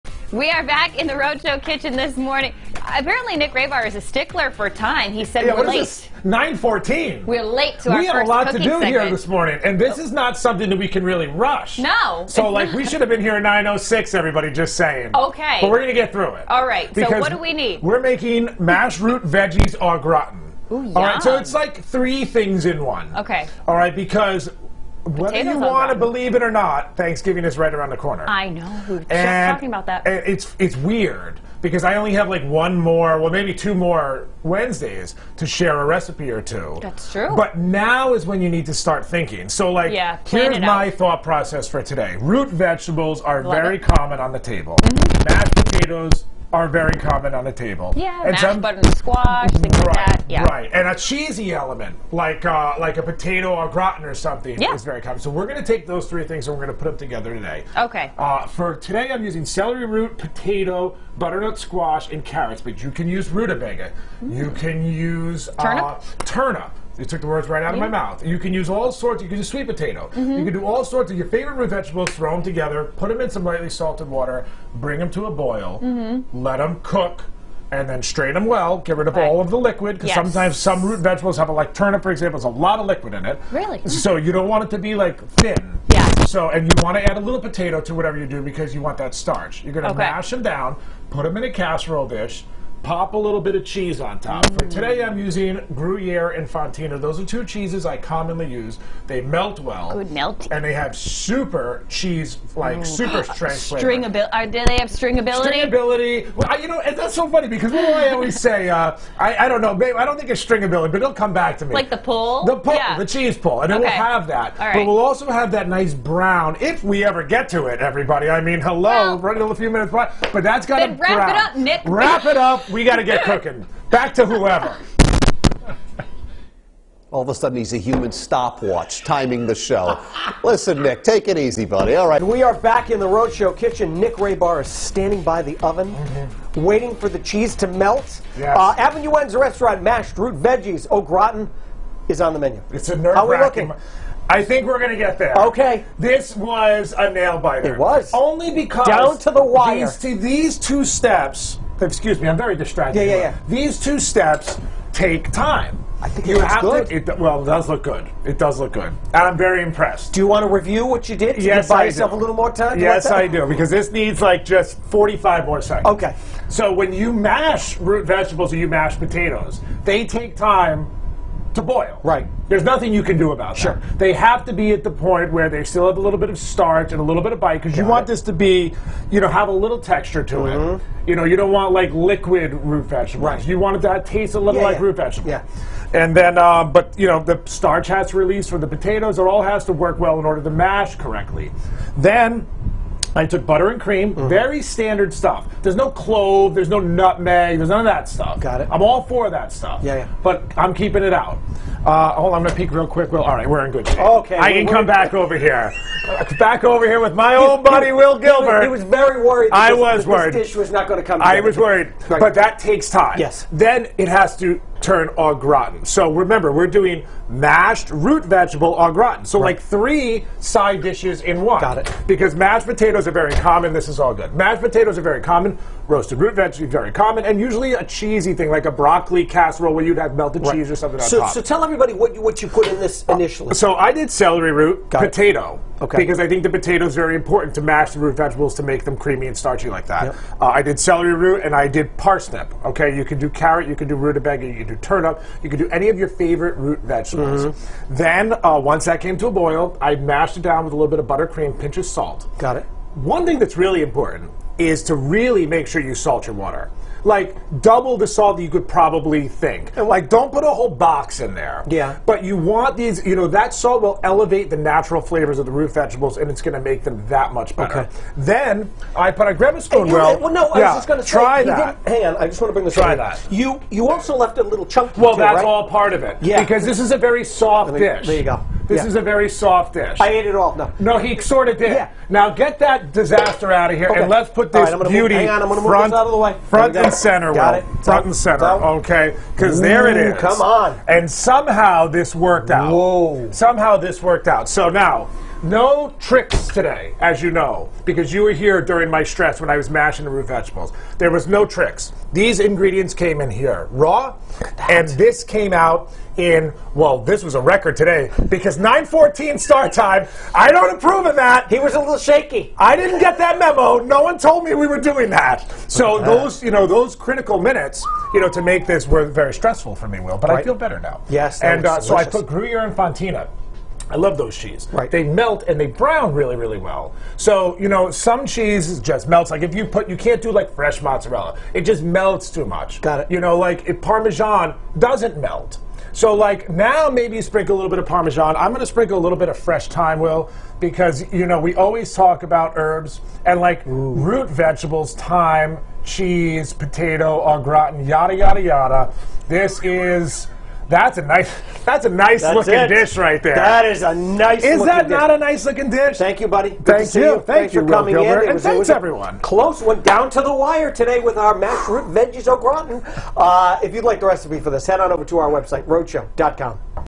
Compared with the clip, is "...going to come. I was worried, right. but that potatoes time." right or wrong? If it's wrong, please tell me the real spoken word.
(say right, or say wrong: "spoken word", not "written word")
wrong: "takes", not "potatoes".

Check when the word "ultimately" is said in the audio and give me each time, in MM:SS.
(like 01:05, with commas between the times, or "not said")
not said.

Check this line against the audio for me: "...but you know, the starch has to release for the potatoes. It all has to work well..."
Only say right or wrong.
right.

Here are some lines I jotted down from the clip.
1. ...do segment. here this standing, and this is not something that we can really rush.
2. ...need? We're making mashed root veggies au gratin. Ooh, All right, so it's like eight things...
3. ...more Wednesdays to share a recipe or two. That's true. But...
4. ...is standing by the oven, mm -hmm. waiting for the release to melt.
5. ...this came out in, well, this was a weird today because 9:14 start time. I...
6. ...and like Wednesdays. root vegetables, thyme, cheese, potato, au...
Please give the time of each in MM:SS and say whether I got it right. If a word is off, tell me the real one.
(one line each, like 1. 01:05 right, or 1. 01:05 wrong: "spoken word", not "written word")
1. 00:08 wrong: "morning", not "standing"
2. 00:17 wrong: "three", not "eight"
3. 00:33 right
4. 02:14 wrong: "cheese", not "release"
5. 05:04 wrong: "record", not "weird"
6. 05:43 wrong: "Ooh", not "Wednesdays".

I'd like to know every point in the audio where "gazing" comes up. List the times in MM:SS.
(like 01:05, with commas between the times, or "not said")
not said.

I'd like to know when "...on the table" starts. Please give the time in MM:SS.
00:44.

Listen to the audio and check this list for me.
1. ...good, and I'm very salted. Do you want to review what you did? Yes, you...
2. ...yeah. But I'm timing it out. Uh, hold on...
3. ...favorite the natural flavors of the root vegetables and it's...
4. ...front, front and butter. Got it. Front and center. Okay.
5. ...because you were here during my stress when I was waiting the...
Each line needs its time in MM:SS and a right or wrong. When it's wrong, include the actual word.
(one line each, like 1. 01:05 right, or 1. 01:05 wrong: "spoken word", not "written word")
1. 02:38 wrong: "impressed", not "salted"
2. 03:19 wrong: "keeping", not "timing"
3. 04:24 wrong: "elevate", not "favorite"
4. 04:45 wrong: "center", not "butter"
5. 04:57 wrong: "mashing", not "waiting".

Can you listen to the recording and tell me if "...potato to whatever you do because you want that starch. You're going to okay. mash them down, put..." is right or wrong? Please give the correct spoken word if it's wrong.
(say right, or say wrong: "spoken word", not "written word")
right.